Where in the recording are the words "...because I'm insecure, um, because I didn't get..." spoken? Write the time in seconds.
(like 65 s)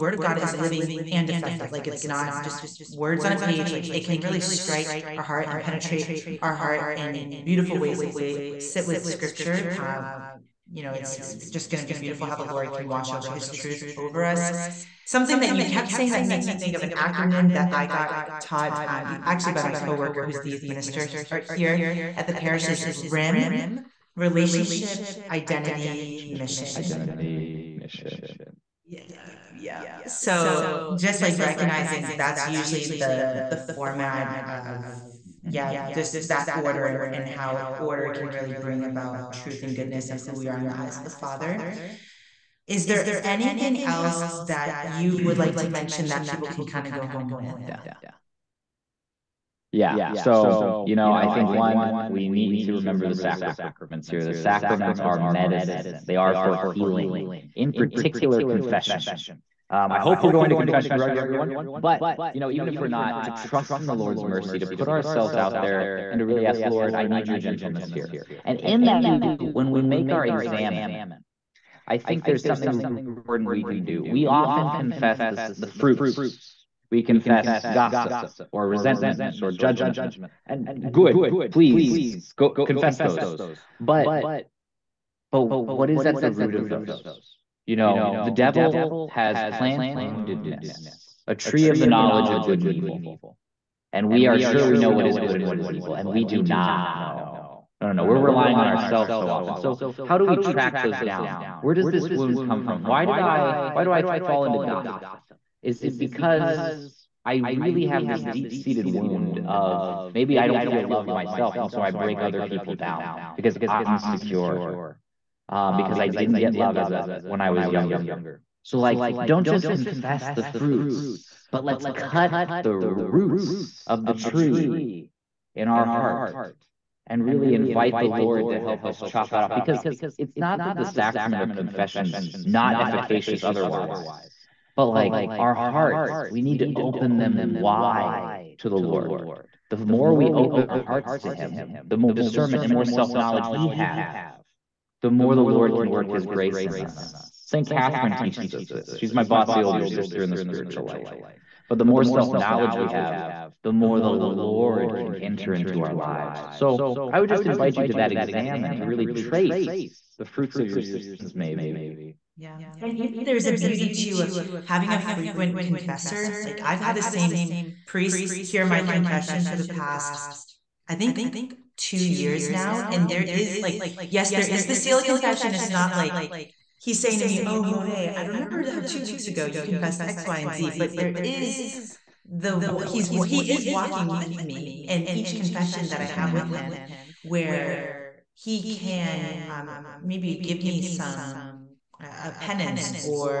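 113 s.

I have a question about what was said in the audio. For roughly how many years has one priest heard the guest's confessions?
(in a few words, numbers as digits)
2.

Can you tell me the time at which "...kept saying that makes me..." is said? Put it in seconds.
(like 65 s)
15 s.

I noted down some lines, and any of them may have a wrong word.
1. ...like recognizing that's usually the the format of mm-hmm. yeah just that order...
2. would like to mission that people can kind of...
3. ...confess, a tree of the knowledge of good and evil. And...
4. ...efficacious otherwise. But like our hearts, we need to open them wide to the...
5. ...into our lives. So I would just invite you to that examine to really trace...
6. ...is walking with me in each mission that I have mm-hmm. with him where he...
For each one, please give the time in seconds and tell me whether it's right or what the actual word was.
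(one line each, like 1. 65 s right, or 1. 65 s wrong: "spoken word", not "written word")
1. 31 s right
2. 45 s wrong: "mention", not "mission"
3. 89 s wrong: "woundedness", not "confess"
4. 132 s right
5. 155 s right
6. 183 s wrong: "confession", not "mission".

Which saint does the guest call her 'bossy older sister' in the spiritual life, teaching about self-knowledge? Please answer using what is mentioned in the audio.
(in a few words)
St. Catherine.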